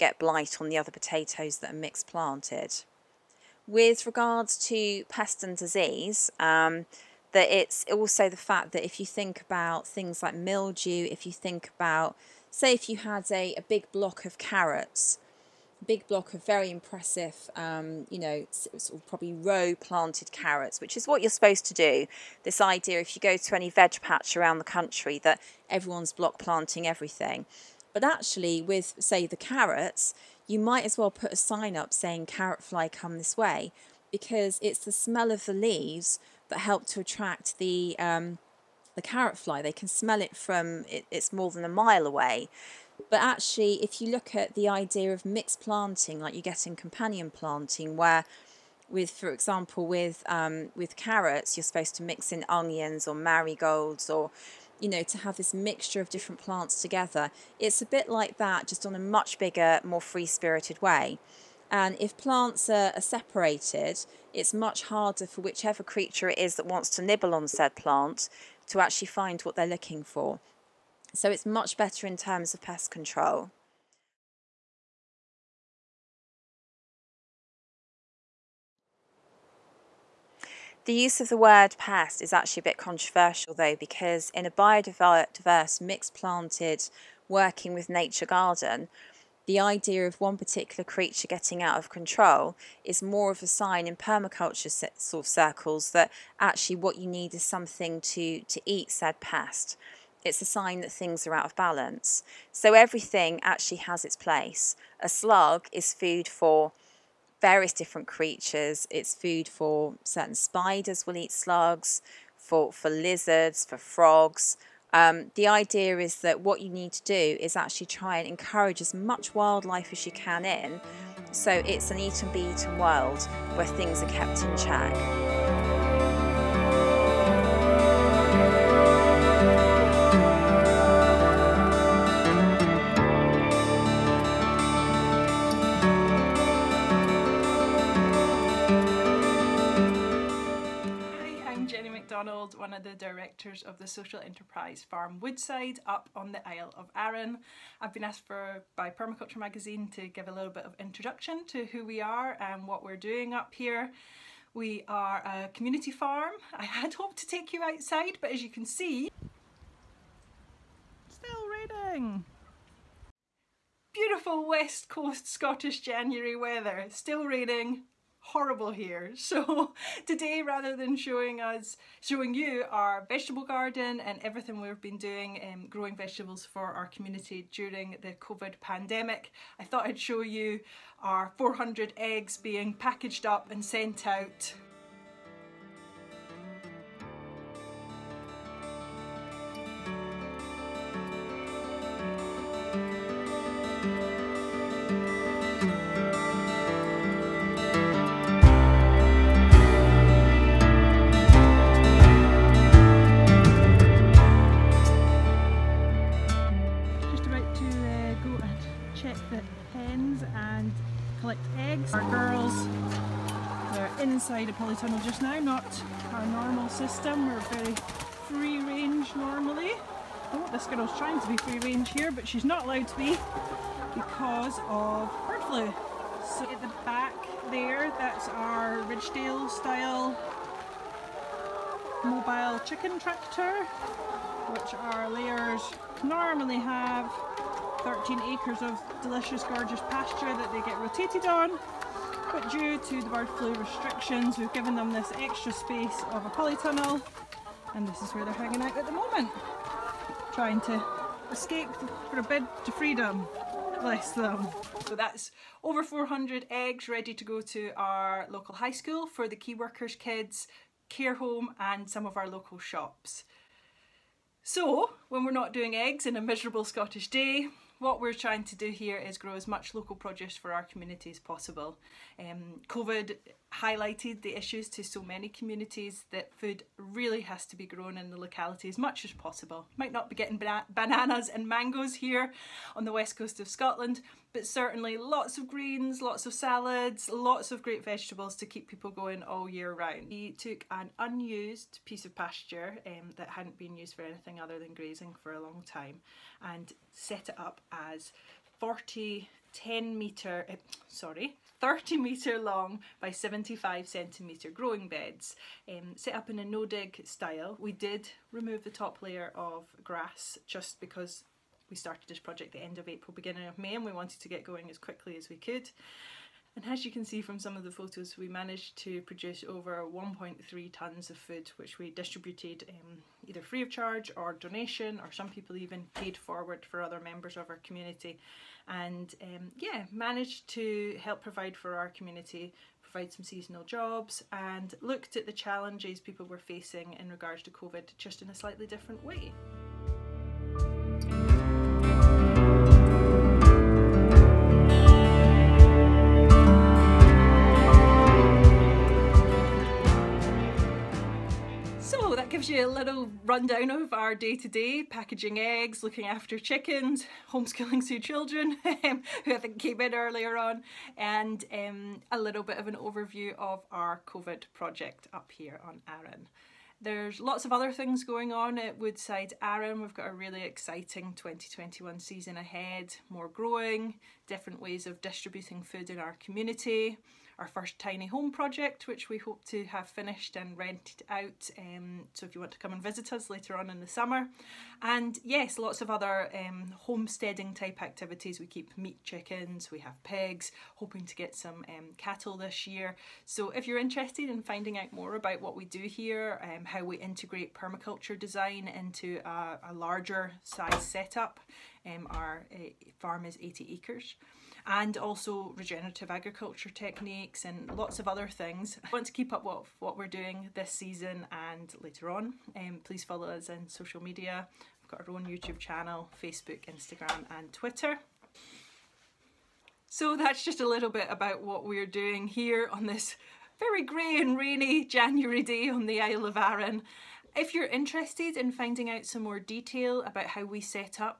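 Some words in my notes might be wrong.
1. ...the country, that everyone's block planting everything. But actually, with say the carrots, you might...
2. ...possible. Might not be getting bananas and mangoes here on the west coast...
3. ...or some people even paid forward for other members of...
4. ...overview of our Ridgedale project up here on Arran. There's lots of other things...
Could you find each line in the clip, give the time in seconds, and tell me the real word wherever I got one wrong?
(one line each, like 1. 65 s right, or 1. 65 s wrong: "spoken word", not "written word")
1. 24 s right
2. 279 s right
3. 324 s right
4. 362 s wrong: "COVID", not "Ridgedale".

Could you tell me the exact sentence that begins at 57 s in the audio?
It's a bit like that, just on a much bigger, more free spirited way.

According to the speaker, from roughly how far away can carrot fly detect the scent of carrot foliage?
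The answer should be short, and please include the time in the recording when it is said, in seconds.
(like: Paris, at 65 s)
More than a mile, at 41 s.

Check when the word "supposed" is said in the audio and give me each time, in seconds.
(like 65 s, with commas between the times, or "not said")
21 s, 51 s.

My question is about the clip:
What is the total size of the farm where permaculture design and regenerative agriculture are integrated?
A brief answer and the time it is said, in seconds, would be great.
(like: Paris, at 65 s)
80 acres, at 403 s.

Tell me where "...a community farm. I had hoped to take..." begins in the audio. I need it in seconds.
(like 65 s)
155 s.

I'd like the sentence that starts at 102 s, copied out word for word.
So everything actually has its place.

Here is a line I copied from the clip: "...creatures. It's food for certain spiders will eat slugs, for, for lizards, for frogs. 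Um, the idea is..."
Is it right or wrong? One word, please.
right.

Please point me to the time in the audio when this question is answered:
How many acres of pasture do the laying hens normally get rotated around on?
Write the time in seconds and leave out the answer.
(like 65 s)
237 s.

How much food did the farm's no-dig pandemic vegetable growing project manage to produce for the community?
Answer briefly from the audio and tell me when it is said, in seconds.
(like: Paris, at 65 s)
Over 1.3 tonnes, at 319 s.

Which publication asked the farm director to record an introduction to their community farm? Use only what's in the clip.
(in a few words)
Permaculture Magazine.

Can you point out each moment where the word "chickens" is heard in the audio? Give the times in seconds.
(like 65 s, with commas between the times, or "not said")
232 s, 356 s, 389 s.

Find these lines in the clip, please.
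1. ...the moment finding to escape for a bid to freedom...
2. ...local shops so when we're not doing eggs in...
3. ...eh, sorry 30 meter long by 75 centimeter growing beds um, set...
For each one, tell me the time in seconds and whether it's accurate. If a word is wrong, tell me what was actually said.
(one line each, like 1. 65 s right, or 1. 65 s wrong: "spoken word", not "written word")
1. 248 s wrong: "trying", not "finding"
2. 262 s right
3. 300 s right.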